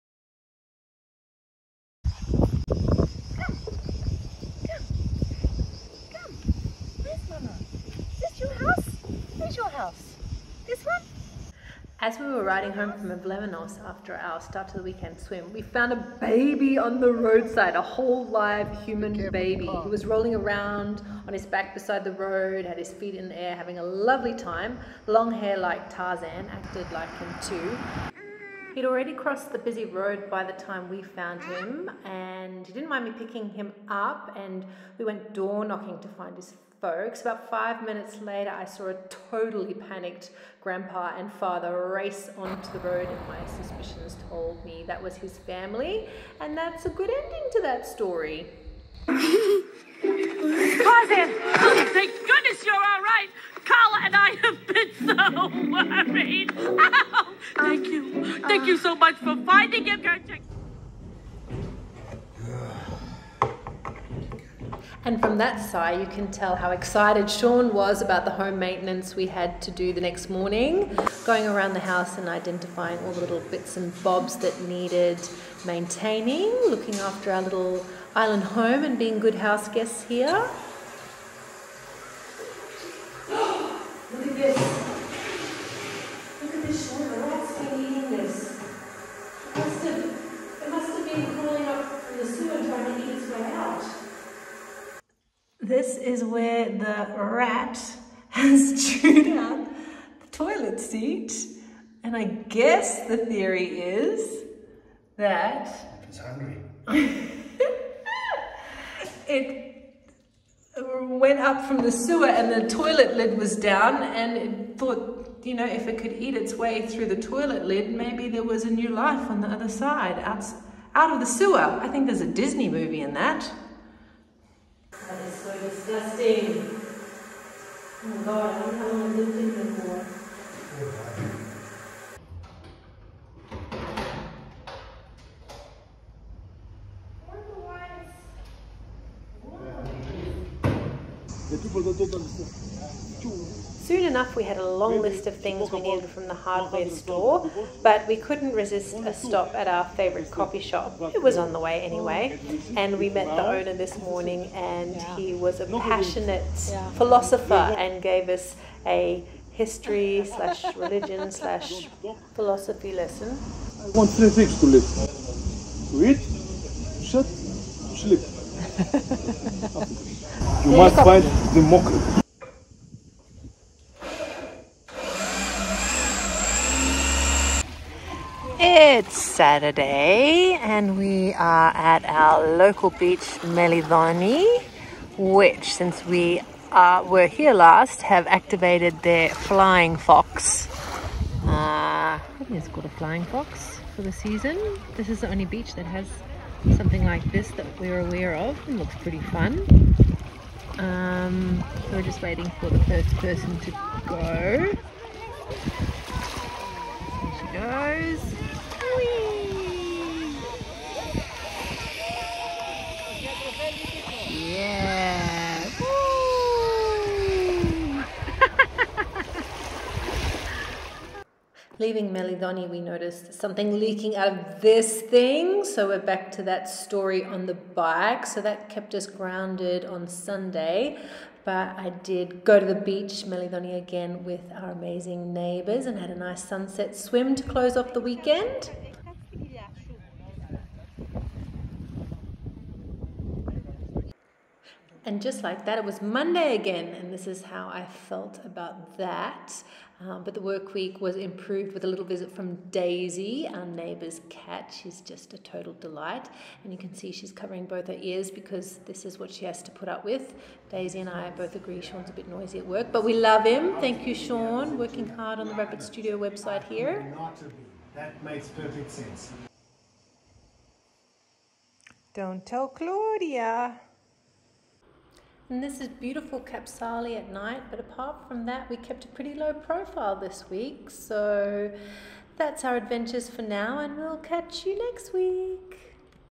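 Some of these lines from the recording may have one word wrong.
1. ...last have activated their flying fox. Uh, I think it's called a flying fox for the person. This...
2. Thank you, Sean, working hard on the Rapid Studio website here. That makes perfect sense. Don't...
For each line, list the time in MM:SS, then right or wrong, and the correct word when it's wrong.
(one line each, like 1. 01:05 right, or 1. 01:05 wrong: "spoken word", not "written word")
1. 03:07 wrong: "season", not "person"
2. 04:23 right.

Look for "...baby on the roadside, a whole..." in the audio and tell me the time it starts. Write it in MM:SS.
00:16.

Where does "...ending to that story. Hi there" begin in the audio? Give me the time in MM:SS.
00:47.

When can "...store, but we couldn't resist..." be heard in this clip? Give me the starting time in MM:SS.
02:26.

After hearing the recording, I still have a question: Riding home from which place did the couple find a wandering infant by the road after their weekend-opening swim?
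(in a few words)
Avlemonos.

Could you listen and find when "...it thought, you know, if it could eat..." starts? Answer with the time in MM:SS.
01:54.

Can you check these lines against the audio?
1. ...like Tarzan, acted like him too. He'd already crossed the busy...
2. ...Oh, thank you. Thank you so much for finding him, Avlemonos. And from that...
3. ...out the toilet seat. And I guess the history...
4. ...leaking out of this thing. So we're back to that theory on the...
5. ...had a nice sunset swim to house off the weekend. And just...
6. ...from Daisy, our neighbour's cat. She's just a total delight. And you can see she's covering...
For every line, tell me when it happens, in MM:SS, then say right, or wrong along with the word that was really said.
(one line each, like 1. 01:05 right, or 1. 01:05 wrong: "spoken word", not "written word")
1. 00:25 right
2. 00:57 wrong: "Gertrude", not "Avlemonos"
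3. 01:39 wrong: "theory", not "history"
4. 03:43 wrong: "story", not "theory"
5. 03:55 wrong: "close", not "house"
6. 04:12 right.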